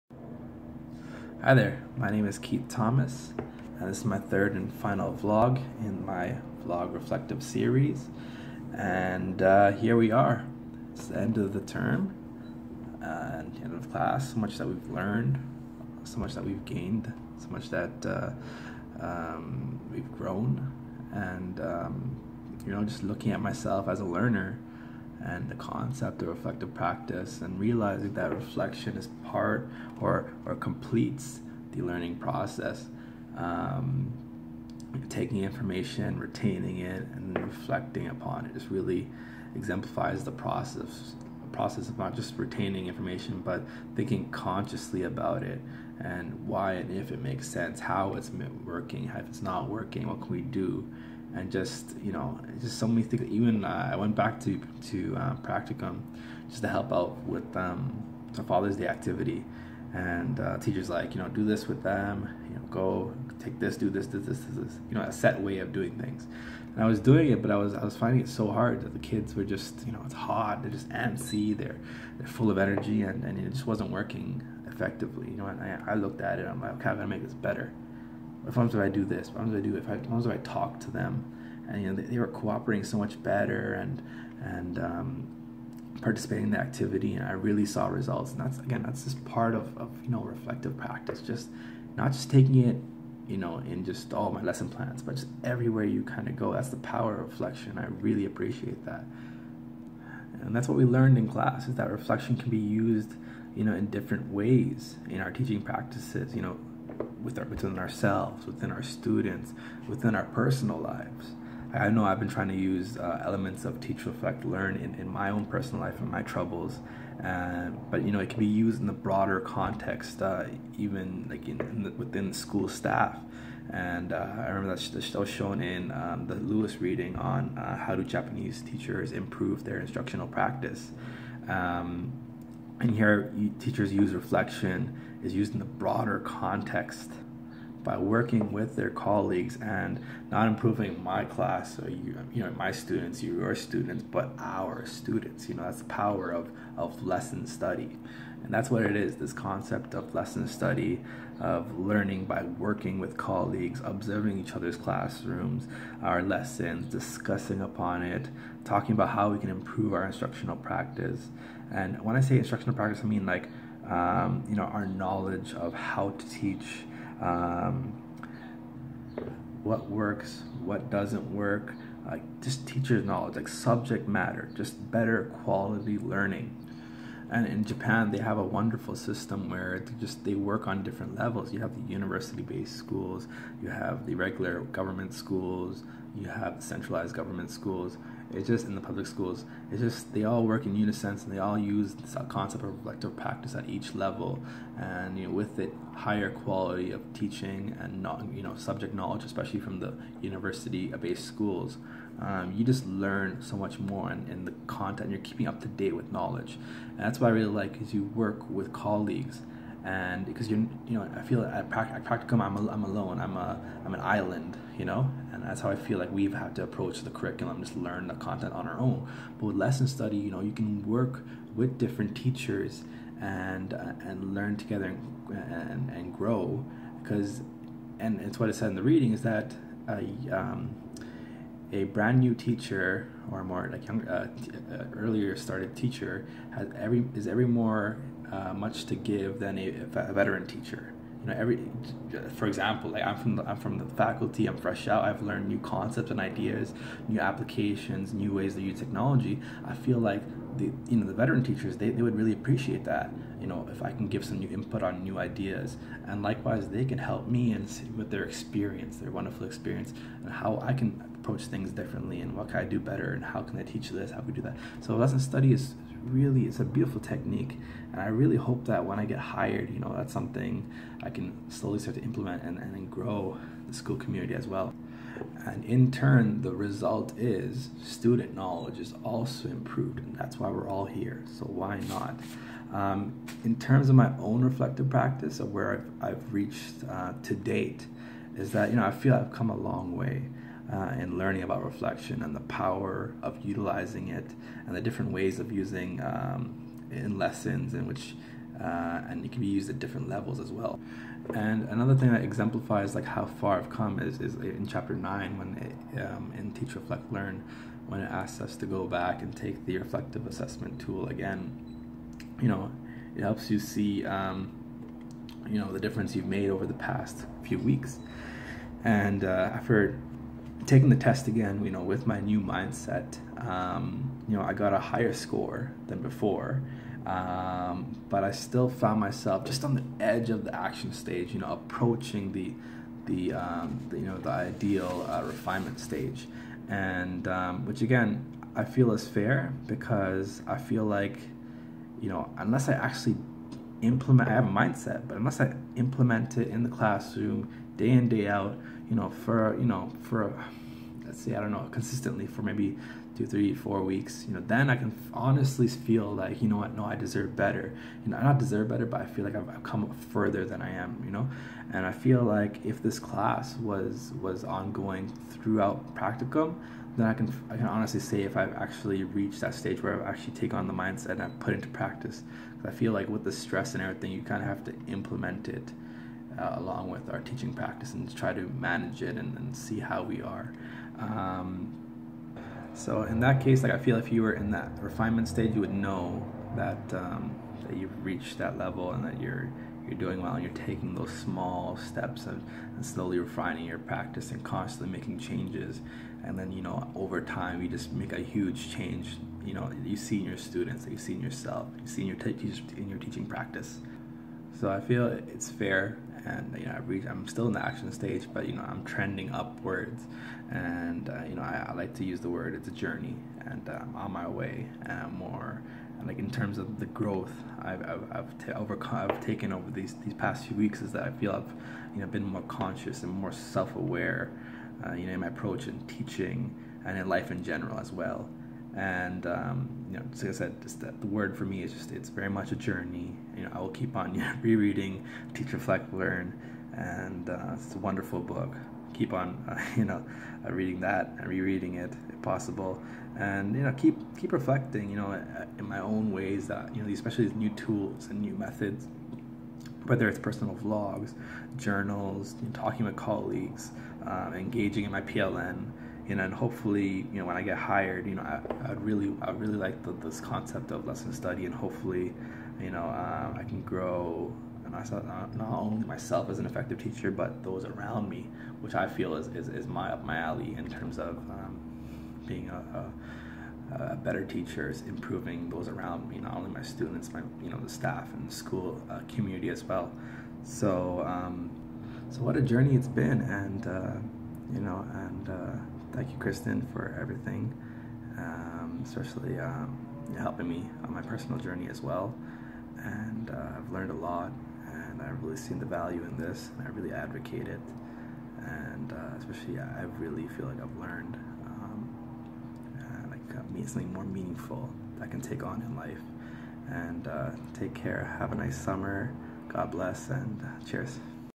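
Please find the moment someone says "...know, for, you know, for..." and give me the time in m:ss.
5:48.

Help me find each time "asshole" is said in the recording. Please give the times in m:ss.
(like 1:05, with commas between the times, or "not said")
not said.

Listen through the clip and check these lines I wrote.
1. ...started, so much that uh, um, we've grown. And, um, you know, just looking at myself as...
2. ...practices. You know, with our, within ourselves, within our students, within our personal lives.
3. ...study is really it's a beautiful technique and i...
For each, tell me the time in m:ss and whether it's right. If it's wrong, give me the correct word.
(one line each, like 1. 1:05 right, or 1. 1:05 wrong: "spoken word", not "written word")
1. 0:16 wrong: "gained", not "started"
2. 1:45 right
3. 4:25 right.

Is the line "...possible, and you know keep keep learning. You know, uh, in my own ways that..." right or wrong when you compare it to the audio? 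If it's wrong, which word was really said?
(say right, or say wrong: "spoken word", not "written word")
wrong: "reflecting", not "learning".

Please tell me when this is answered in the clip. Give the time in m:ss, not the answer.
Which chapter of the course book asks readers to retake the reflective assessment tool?
5:04.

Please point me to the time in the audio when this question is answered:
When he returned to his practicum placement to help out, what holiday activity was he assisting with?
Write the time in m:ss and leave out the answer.
0:58.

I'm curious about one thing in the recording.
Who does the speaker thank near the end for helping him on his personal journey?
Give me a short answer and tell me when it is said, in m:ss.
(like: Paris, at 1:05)
Kristen, at 8:06.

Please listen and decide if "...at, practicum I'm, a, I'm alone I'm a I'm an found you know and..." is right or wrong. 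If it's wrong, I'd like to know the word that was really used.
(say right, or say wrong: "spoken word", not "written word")
wrong: "island", not "found".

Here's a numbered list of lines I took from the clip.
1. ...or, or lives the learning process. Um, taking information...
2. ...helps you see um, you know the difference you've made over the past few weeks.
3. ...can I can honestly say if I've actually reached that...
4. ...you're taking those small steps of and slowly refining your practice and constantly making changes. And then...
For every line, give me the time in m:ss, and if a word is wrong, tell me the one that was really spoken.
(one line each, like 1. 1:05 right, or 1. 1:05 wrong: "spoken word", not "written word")
1. 0:29 wrong: "completes", not "lives"
2. 5:13 right
3. 6:07 right
4. 6:30 right.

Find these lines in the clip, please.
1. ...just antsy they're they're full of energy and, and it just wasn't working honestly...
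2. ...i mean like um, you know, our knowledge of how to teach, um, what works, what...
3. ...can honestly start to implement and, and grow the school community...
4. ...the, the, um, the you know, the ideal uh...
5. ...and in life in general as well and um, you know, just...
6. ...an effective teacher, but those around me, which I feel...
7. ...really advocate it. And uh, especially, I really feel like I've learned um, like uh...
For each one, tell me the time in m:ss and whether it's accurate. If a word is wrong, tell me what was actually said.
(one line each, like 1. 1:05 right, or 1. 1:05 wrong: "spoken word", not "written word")
1. 1:10 wrong: "effectively", not "honestly"
2. 2:43 right
3. 4:31 wrong: "slowly", not "honestly"
4. 5:32 right
5. 7:06 right
6. 7:46 right
7. 8:16 right.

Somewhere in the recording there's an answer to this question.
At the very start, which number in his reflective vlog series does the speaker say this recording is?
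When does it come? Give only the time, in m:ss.
0:04.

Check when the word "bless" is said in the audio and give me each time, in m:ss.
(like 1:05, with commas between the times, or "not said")
8:29.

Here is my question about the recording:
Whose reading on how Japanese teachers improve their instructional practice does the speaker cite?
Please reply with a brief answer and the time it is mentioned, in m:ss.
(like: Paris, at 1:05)
Lewis, at 2:06.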